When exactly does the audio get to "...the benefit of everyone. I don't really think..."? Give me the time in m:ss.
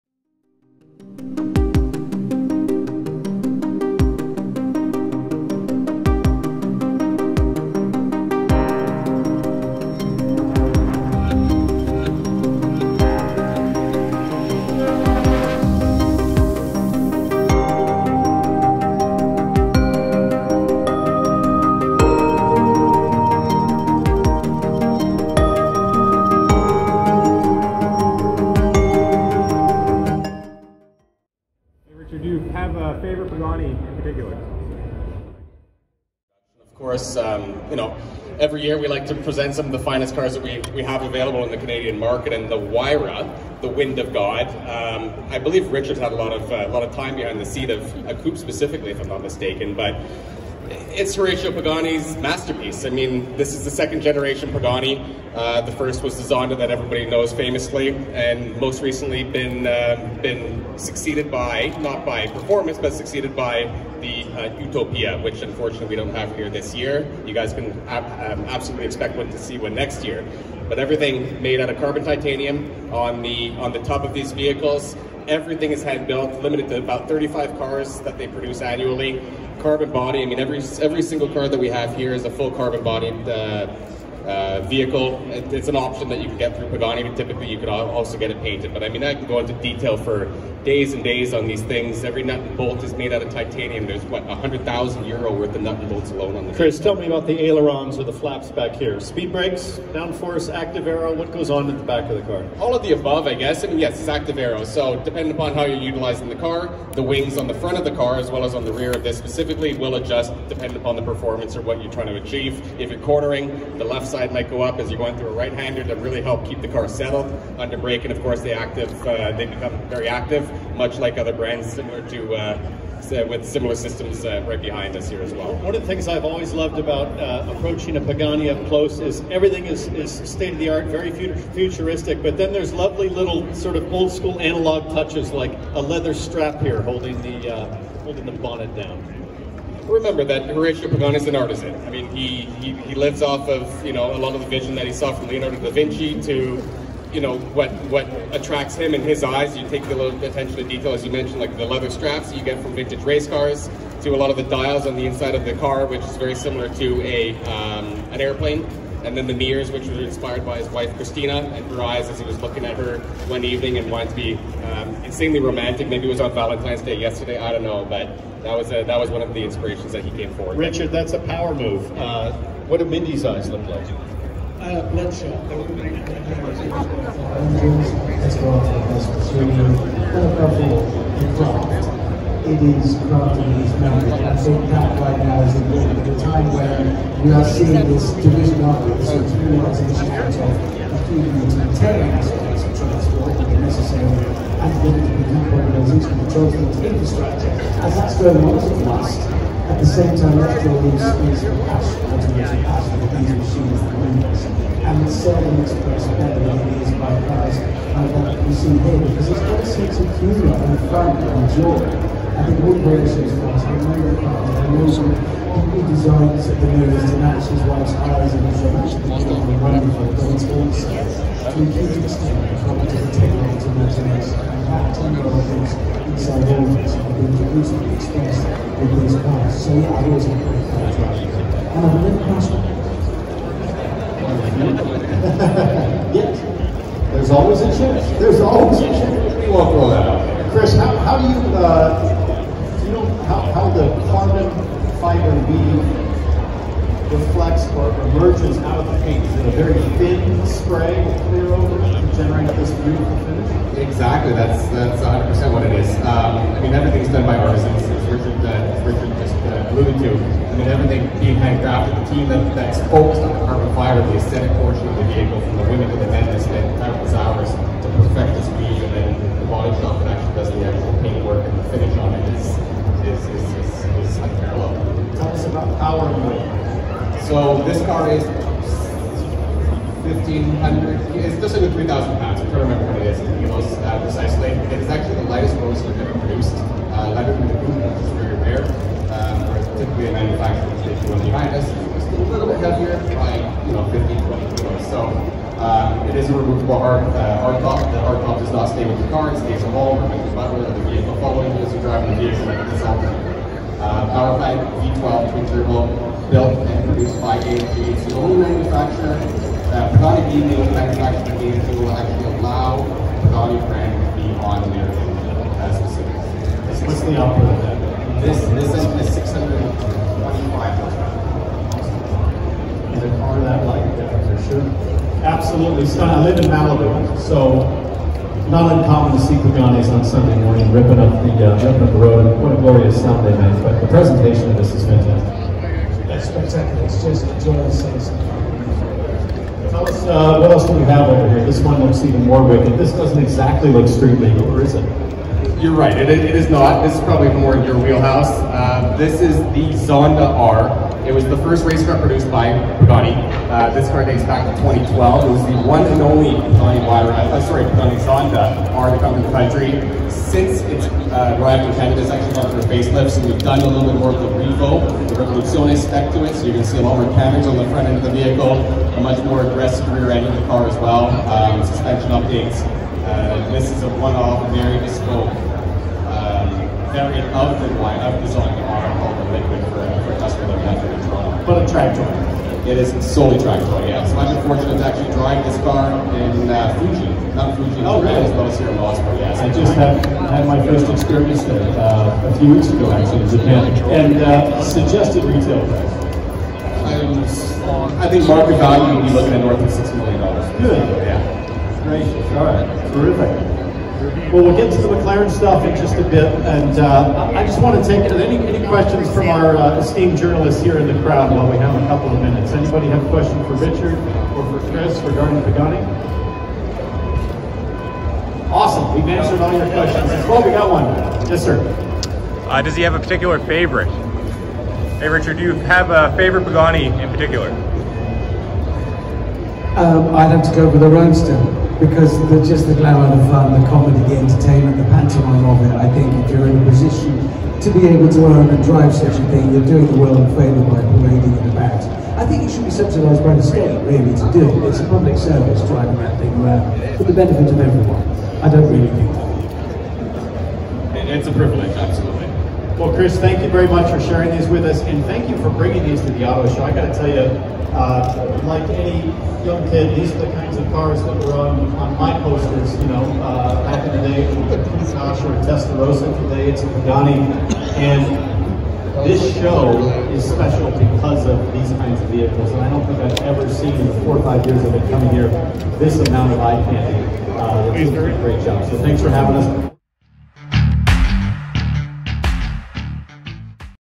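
7:27.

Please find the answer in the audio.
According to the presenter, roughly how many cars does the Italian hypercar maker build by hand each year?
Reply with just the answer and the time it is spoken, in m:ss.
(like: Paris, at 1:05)
35, at 1:17.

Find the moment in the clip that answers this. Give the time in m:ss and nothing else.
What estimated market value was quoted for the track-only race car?
6:39.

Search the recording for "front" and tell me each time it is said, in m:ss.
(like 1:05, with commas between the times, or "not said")
1:47, 6:07.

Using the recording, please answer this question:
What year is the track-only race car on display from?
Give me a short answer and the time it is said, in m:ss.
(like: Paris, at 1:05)
2012, at 5:54.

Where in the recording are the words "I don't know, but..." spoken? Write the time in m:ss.
2:47.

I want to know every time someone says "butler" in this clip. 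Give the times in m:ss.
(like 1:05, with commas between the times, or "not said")
5:00.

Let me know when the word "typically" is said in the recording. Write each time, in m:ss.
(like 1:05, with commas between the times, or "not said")
1:27, 4:49.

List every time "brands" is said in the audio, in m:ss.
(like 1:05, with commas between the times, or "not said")
2:01, 5:13.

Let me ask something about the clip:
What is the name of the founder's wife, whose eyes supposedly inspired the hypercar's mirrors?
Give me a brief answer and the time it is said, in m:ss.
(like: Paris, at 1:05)
Christina, at 2:40.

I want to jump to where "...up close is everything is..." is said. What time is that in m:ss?
2:08.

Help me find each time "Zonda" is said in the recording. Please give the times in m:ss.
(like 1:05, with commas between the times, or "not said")
0:56, 5:49, 5:58.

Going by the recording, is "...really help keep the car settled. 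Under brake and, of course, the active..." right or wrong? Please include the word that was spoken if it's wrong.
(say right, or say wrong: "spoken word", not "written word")
right.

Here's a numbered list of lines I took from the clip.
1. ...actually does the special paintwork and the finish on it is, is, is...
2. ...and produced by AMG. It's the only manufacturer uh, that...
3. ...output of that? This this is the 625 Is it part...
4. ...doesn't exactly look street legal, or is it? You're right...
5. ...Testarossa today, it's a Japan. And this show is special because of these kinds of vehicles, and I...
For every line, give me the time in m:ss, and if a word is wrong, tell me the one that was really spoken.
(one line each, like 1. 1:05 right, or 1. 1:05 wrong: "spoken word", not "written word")
1. 4:30 wrong: "actual", not "special"
2. 5:06 right
3. 5:17 right
4. 5:42 right
5. 7:45 wrong: "Pagani", not "Japan".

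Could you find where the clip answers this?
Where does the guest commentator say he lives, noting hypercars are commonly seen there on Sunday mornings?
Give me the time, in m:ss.
5:26.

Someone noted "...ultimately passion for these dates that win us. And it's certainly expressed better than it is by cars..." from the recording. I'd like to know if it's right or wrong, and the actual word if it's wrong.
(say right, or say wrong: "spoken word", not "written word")
wrong: "machines", not "dates".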